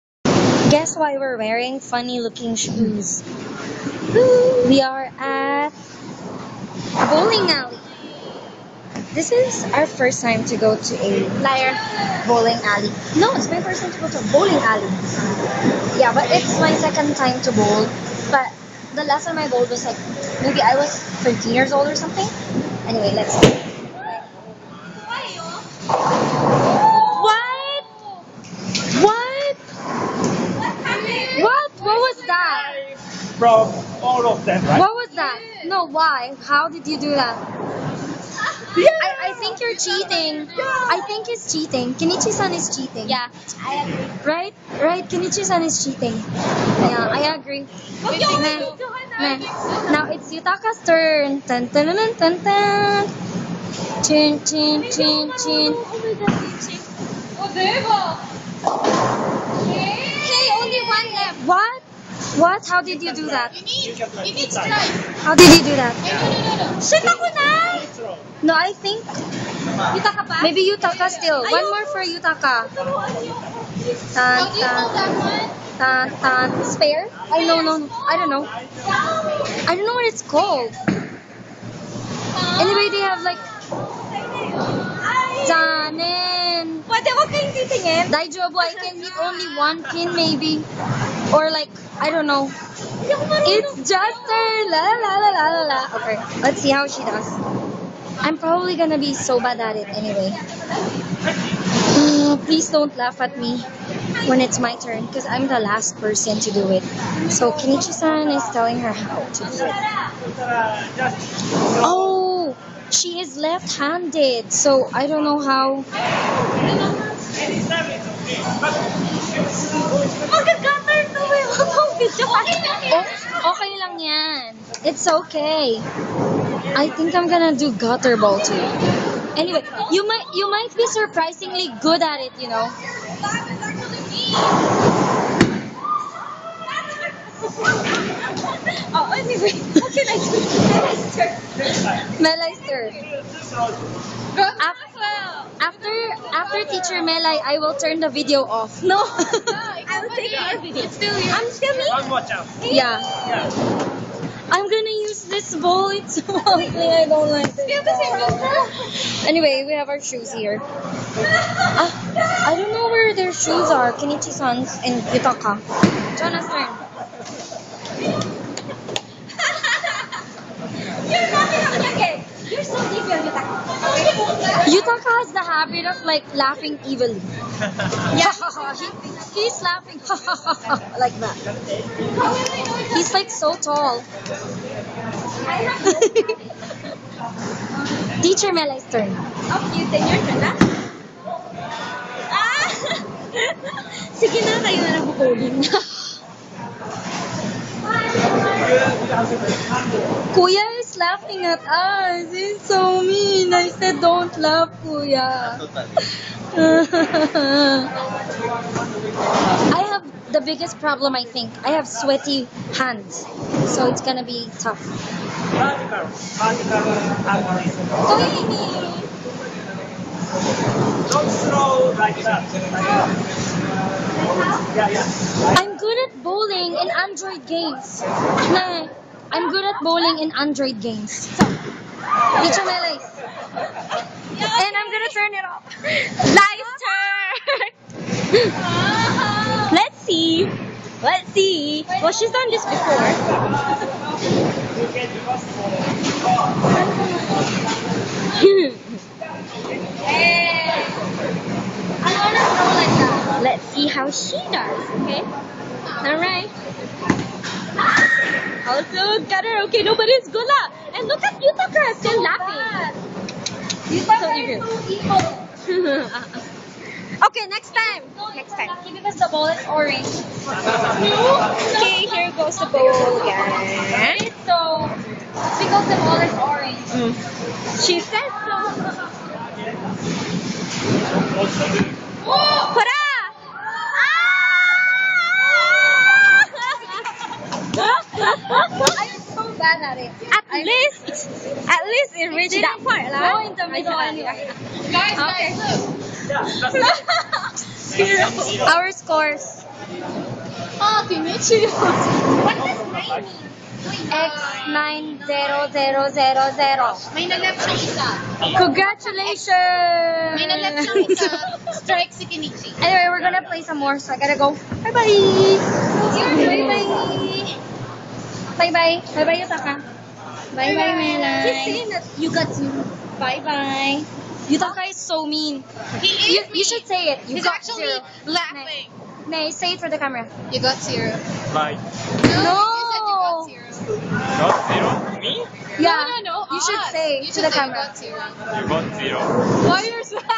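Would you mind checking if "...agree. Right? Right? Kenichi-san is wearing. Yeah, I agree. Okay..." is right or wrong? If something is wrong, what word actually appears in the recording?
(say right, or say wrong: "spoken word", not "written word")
wrong: "cheating", not "wearing".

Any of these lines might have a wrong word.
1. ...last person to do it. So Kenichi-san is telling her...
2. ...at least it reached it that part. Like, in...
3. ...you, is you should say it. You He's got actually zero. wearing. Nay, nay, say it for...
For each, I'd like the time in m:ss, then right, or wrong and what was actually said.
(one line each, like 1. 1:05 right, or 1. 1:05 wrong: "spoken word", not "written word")
1. 1:45 right
2. 4:51 right
3. 5:26 wrong: "laughing", not "wearing".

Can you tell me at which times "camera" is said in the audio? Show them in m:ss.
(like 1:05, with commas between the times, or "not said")
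5:29, 5:37.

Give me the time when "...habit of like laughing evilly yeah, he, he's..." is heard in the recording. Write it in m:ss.
2:55.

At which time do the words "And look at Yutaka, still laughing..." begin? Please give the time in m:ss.
4:20.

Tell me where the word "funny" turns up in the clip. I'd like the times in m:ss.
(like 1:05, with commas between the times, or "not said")
0:01.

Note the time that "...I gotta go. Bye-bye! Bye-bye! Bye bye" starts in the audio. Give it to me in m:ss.
5:14.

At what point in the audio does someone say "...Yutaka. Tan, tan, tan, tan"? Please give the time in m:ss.
1:12.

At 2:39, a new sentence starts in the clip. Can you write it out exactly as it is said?
Anyway, we have our shoes here.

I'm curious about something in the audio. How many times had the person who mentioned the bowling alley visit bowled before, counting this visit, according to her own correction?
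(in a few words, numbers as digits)
second time.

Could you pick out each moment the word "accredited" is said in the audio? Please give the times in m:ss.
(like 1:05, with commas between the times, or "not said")
not said.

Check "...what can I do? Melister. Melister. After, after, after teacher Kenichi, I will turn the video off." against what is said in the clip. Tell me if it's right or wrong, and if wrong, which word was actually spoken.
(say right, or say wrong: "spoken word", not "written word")
wrong: "Melai", not "Kenichi".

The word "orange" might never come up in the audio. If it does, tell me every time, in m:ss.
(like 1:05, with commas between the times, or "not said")
4:29, 4:36.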